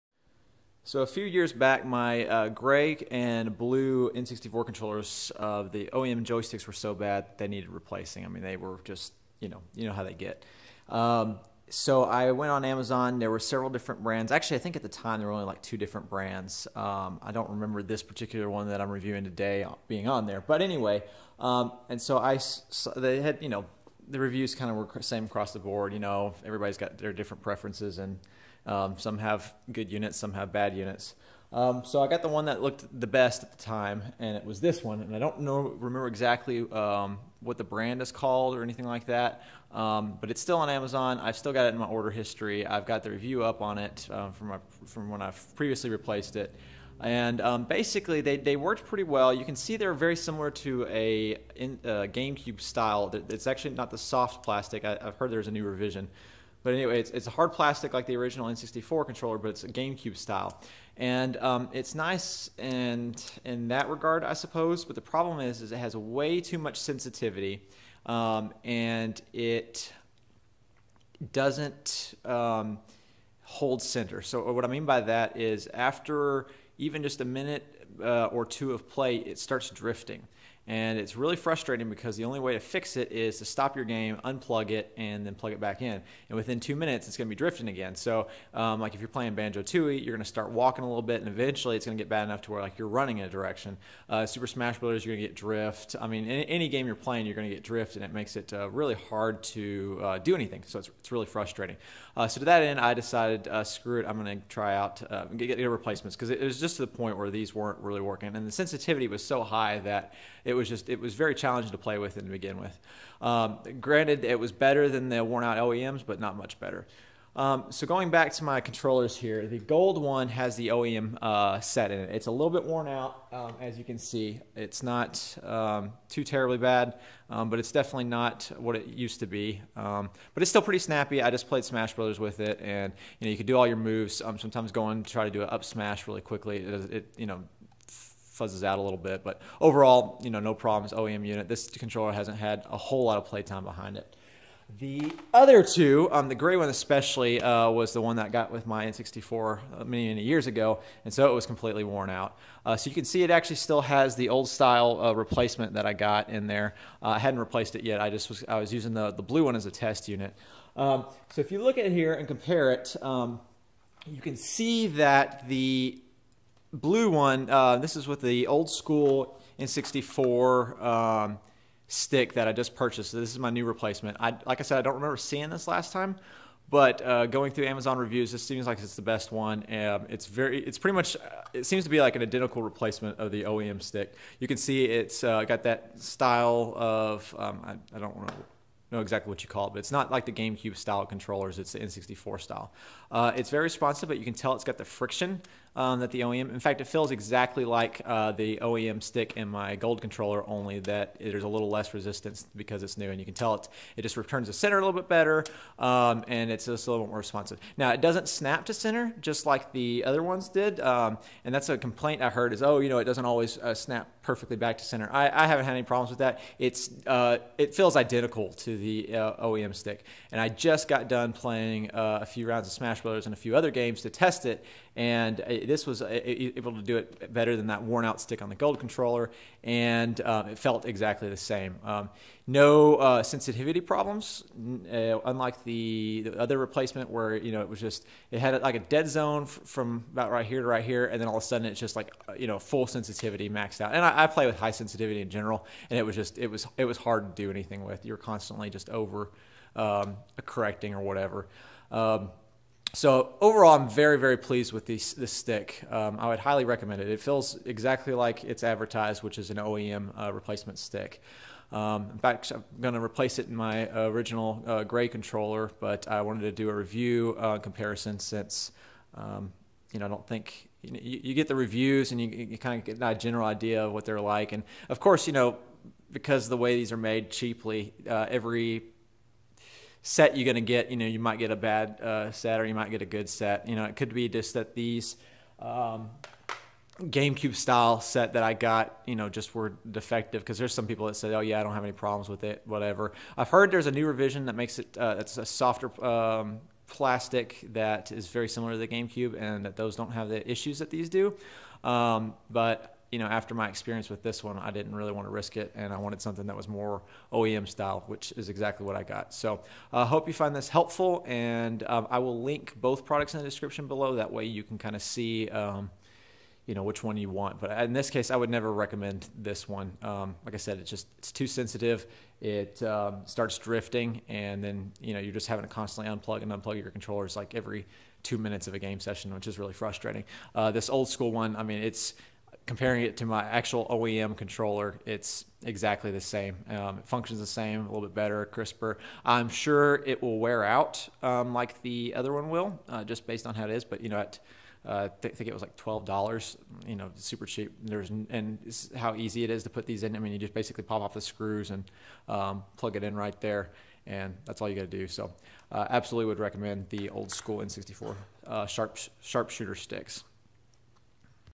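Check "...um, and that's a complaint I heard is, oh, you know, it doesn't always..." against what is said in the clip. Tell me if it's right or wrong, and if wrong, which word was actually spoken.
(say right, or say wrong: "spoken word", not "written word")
right.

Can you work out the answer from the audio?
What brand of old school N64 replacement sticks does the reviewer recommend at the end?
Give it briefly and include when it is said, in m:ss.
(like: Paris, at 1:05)
Sharpshooter, at 5:59.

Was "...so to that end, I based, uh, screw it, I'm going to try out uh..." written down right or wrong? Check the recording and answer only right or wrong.
wrong.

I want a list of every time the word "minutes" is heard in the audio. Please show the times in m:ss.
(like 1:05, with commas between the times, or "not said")
1:17, 1:26, 5:28.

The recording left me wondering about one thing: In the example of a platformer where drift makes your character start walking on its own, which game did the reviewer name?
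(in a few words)
Banjo Tooie.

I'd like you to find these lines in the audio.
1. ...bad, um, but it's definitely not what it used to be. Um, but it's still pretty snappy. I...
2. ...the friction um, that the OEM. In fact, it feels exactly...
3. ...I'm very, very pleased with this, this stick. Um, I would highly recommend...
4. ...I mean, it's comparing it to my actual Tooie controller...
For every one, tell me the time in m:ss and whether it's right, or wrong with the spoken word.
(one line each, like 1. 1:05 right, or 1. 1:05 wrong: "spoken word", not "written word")
1. 2:06 right
2. 3:14 right
3. 4:13 right
4. 5:31 wrong: "OEM", not "Tooie".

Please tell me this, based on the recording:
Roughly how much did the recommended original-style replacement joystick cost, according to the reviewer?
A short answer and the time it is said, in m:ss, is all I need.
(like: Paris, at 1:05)
$12, at 5:45.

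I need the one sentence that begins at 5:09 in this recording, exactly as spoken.
So I uh, hope you find this helpful, and um, I will link both products in the description below.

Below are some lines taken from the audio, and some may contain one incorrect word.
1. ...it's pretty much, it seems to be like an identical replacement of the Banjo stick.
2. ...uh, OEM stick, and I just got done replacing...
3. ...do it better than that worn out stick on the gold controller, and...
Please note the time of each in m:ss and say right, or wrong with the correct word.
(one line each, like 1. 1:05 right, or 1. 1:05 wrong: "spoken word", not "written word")
1. 3:00 wrong: "OEM", not "Banjo"
2. 3:39 wrong: "playing", not "replacing"
3. 3:46 right.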